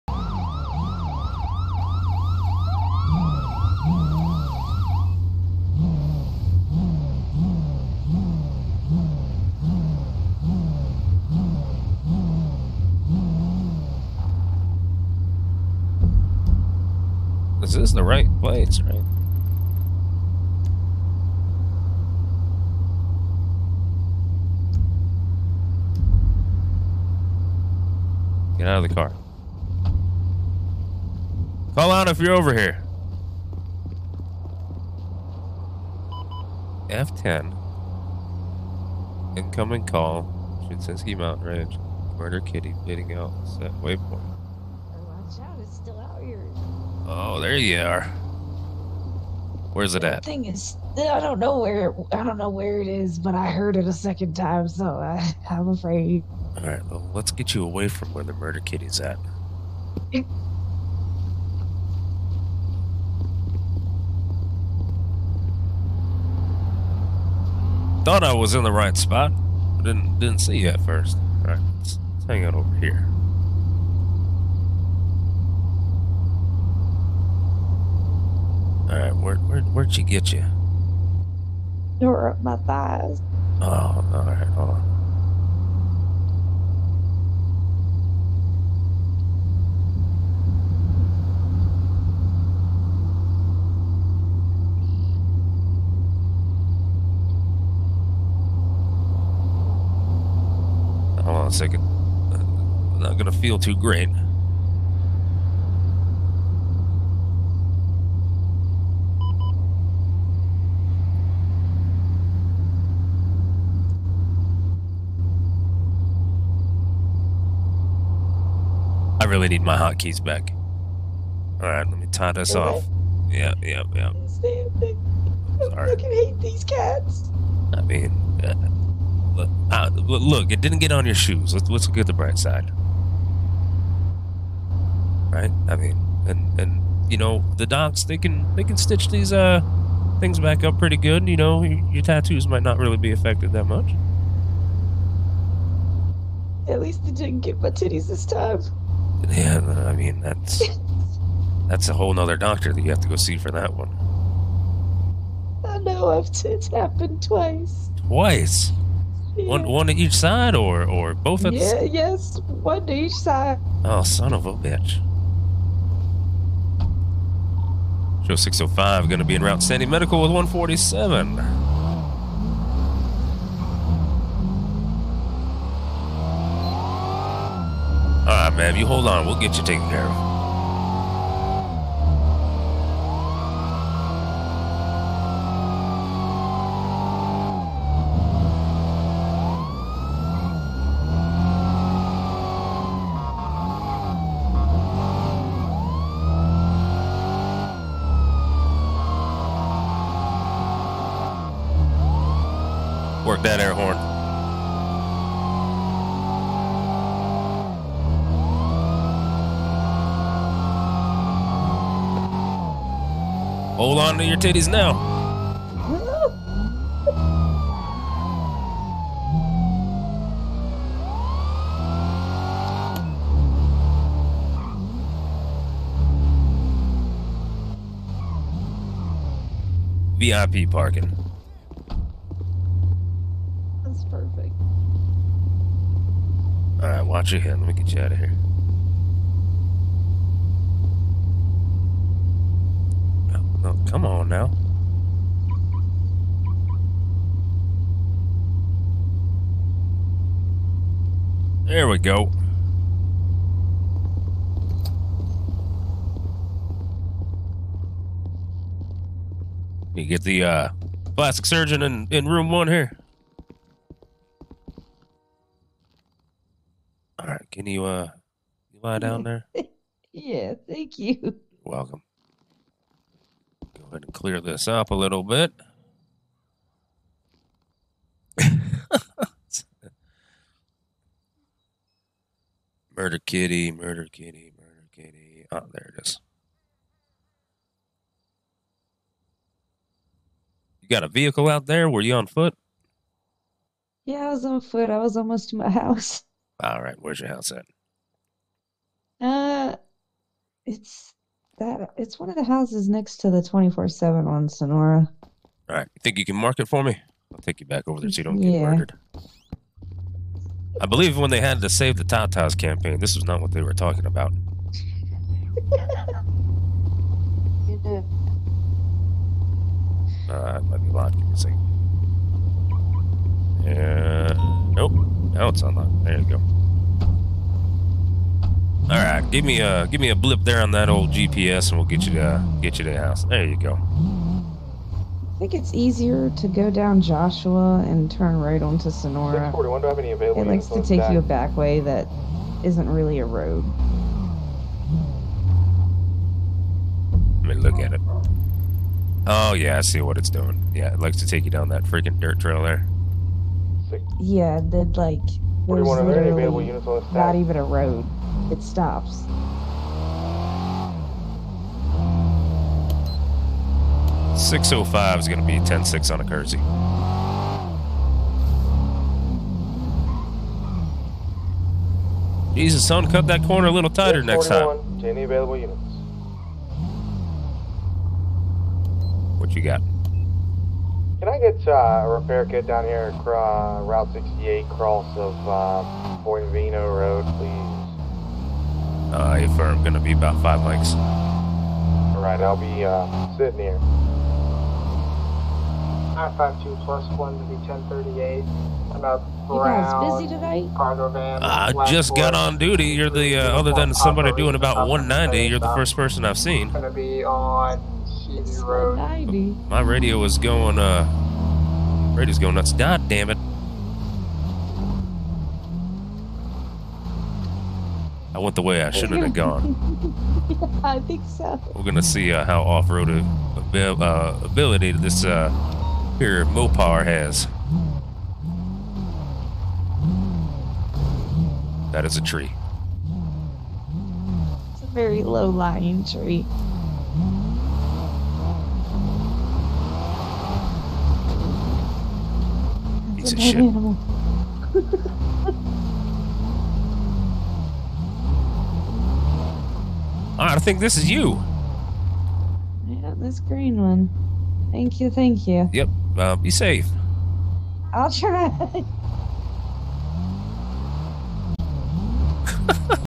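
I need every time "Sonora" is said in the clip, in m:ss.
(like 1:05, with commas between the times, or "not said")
5:04, 5:38.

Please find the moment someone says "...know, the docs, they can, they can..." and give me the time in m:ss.
2:17.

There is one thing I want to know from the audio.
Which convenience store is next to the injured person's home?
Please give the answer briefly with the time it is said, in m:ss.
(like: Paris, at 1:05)
24/7, at 5:03.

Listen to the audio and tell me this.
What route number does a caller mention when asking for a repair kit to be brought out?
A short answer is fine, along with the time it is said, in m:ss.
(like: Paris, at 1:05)
68, at 6:24.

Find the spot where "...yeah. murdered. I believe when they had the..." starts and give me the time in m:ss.
5:08.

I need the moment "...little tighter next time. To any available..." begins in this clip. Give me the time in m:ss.
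6:13.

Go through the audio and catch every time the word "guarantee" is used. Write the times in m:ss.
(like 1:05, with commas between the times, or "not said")
not said.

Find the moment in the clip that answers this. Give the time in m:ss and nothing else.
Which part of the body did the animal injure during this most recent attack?
1:22.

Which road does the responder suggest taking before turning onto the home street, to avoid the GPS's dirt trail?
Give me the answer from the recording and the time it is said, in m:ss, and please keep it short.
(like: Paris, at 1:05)
Joshua, at 5:37.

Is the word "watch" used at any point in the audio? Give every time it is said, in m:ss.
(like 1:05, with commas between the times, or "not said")
0:44, 3:57.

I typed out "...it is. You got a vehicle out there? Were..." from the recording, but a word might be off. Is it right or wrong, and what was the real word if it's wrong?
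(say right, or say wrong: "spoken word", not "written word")
right.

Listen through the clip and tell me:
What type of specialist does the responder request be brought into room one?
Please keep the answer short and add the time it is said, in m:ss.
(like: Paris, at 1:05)
Plastic surgeon, at 4:21.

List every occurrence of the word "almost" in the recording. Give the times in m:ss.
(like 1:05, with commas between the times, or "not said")
4:55.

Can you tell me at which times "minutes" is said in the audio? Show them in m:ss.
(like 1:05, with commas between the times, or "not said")
not said.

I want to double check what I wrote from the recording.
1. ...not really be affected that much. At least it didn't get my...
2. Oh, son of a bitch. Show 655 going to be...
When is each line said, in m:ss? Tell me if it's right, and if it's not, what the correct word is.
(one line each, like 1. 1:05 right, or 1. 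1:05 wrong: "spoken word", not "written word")
1. 2:22 right
2. 2:43 wrong: "605", not "655".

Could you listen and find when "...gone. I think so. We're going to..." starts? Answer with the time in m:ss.
6:59.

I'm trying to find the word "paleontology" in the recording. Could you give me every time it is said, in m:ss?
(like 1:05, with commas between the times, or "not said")
not said.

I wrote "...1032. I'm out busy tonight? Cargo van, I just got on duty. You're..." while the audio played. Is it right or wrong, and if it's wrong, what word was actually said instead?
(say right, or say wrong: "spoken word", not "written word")
wrong: "1038", not "1032".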